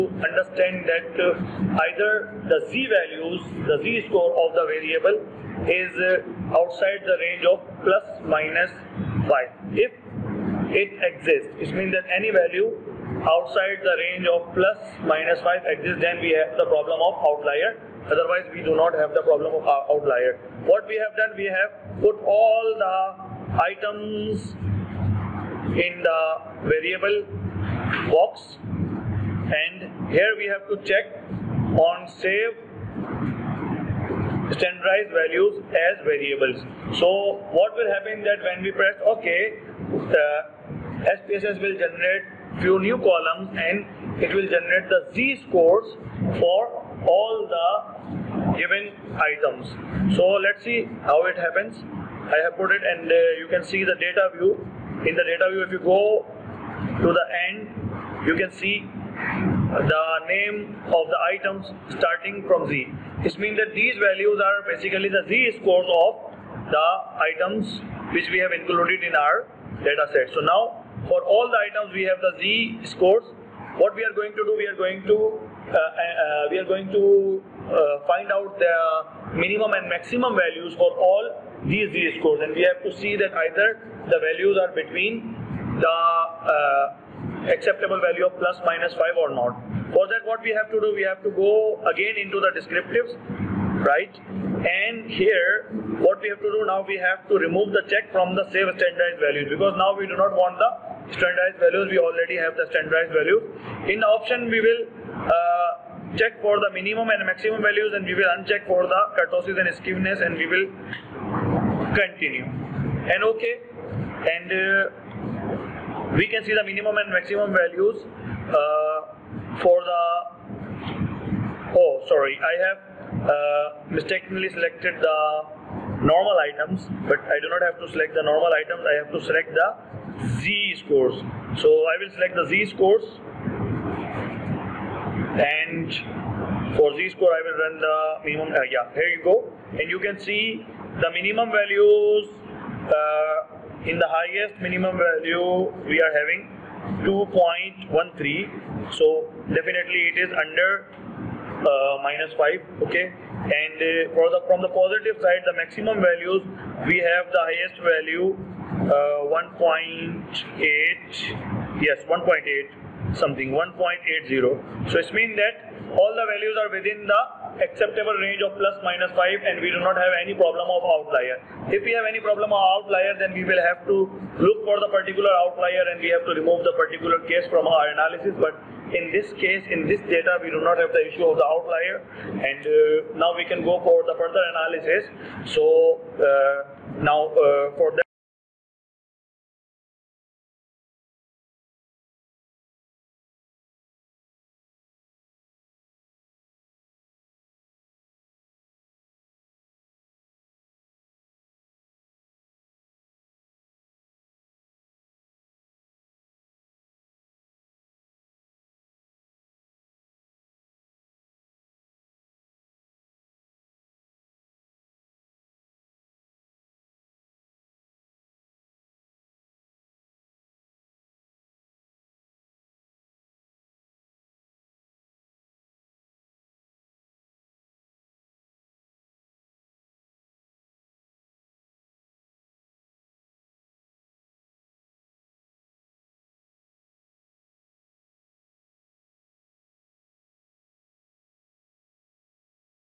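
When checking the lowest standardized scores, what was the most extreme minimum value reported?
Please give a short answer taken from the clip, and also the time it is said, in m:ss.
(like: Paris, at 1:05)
2.13, at 2:27.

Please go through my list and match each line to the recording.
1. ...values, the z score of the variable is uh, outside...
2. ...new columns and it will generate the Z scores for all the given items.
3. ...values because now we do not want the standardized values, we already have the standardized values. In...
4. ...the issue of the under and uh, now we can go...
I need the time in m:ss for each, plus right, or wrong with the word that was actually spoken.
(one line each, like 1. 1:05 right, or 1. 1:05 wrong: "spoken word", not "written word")
1. 0:02 right
2. 0:42 right
3. 1:39 right
4. 3:00 wrong: "outlier", not "under".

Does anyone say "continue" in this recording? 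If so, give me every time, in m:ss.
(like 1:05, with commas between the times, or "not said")
1:51.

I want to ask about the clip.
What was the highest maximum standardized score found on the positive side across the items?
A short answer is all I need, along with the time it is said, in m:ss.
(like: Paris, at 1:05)
1.80, at 2:43.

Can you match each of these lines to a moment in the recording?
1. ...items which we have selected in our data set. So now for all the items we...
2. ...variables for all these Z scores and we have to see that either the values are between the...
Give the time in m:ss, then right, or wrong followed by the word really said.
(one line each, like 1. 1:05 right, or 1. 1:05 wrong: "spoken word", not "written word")
1. 1:07 wrong: "included", not "selected"
2. 1:20 wrong: "values", not "variables".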